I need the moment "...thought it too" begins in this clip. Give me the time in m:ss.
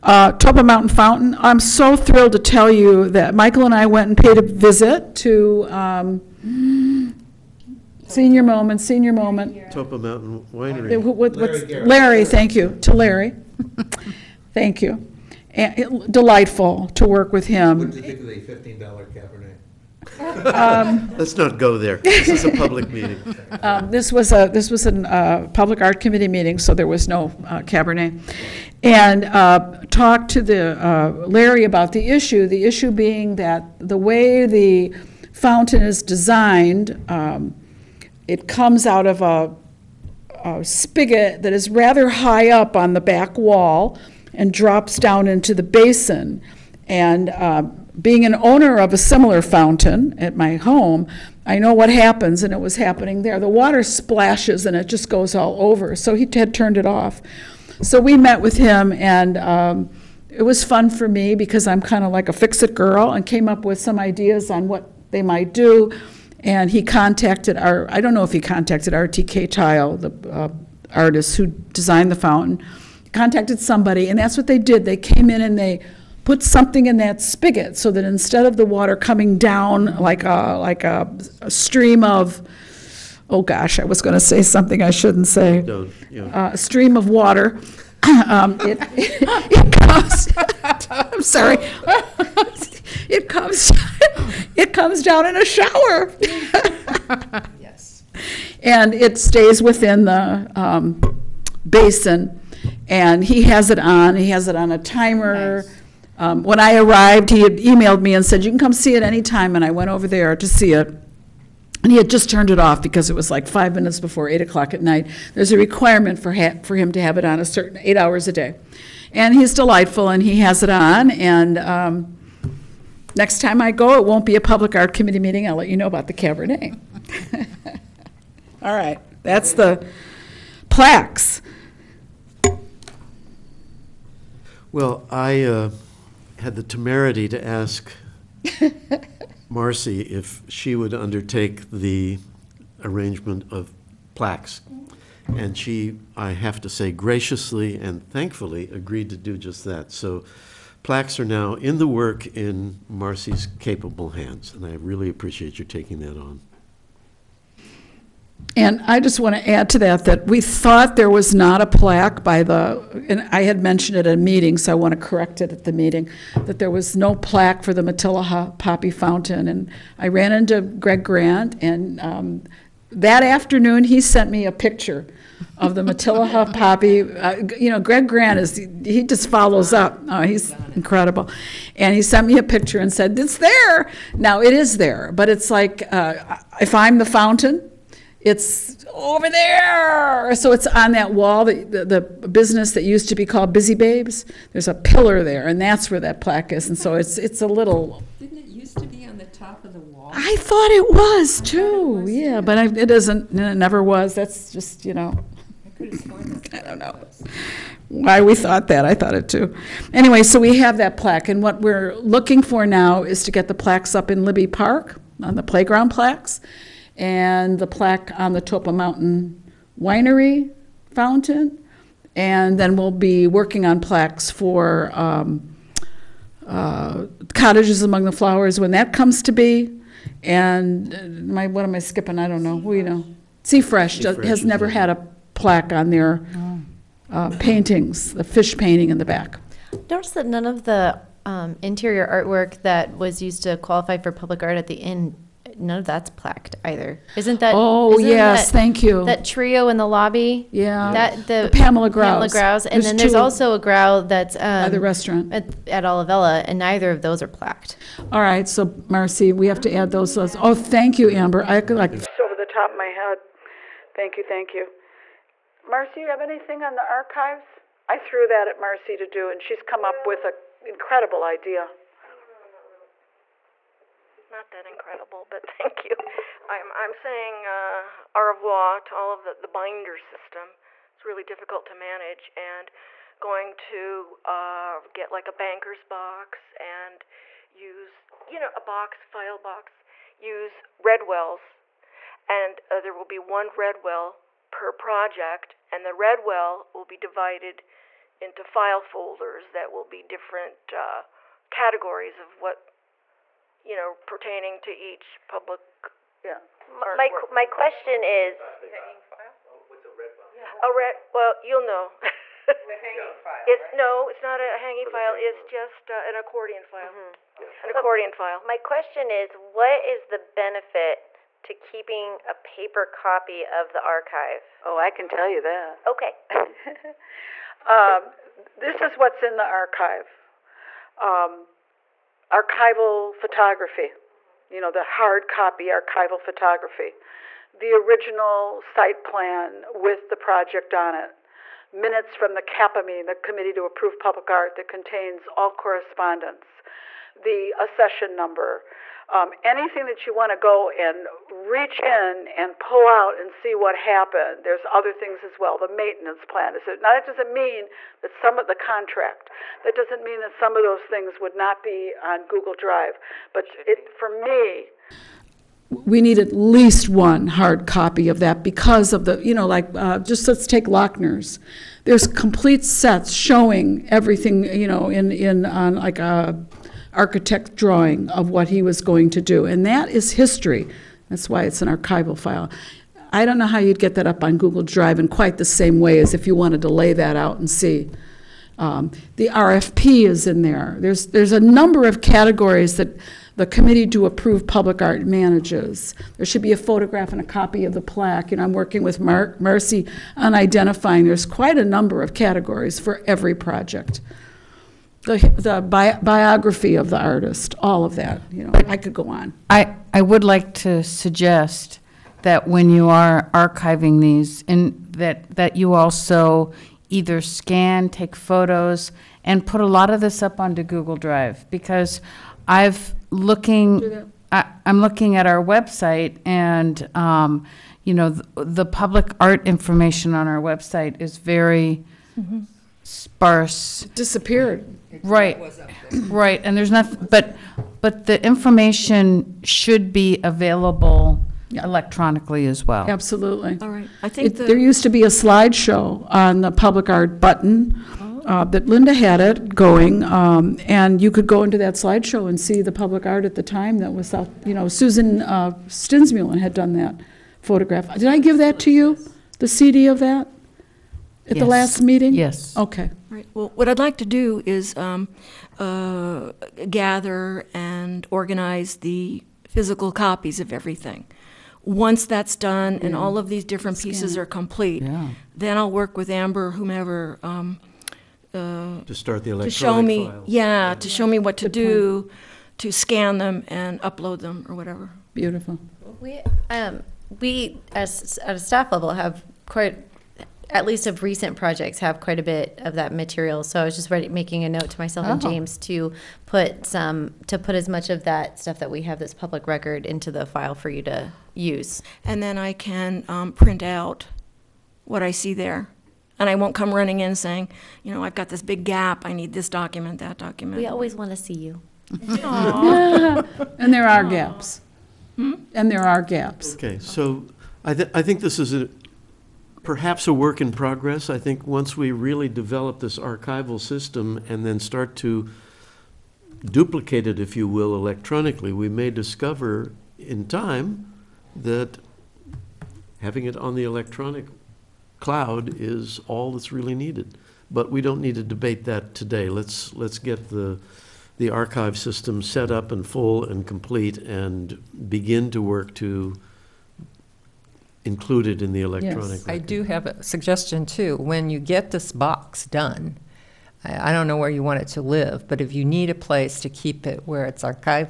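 3:28.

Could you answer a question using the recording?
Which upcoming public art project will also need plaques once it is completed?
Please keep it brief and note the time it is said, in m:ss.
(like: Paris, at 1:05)
Cottages Among the Flowers, at 3:47.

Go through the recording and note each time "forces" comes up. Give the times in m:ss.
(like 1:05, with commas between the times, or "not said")
not said.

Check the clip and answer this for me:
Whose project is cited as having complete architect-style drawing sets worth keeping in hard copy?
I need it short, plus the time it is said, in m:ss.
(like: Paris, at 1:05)
Lochner's, at 6:10.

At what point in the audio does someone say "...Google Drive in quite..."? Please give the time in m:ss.
6:24.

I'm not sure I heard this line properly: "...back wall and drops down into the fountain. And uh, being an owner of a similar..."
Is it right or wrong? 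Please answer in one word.
wrong.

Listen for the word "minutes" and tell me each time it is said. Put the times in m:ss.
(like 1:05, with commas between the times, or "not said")
1:53, 5:41.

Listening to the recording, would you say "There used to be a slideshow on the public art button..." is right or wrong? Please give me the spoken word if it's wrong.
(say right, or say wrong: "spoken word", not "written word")
right.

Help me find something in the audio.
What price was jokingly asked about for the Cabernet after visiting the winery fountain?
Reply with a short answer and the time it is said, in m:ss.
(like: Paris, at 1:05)
$15, at 0:18.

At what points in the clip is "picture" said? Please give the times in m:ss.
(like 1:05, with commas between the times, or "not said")
2:54, 3:02.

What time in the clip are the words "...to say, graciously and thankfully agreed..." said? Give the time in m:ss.
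2:26.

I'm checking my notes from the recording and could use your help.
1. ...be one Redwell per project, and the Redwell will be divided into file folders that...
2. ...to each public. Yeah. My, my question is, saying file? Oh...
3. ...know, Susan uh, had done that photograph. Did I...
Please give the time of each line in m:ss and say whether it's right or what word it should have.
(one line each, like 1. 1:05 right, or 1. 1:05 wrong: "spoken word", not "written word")
1. 4:53 right
2. 5:04 wrong: "hanging", not "saying"
3. 7:34 right.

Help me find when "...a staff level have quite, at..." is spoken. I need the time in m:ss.
8:08.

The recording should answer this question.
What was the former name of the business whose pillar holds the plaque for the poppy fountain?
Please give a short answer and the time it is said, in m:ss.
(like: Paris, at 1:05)
Busy Babes, at 3:13.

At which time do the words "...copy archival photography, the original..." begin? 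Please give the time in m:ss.
5:35.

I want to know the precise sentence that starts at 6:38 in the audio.
And I'm working with Mark Mercy on identifying.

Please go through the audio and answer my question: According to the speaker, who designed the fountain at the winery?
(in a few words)
RTK Tile.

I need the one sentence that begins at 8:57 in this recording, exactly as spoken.
But we don't need to debate that today.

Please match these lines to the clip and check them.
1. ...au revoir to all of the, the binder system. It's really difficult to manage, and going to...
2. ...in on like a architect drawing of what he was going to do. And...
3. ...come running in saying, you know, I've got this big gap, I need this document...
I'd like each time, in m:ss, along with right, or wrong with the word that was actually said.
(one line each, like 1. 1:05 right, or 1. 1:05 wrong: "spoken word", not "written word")
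1. 4:38 right
2. 6:15 right
3. 8:26 right.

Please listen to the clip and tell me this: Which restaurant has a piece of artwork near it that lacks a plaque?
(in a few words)
Olivella.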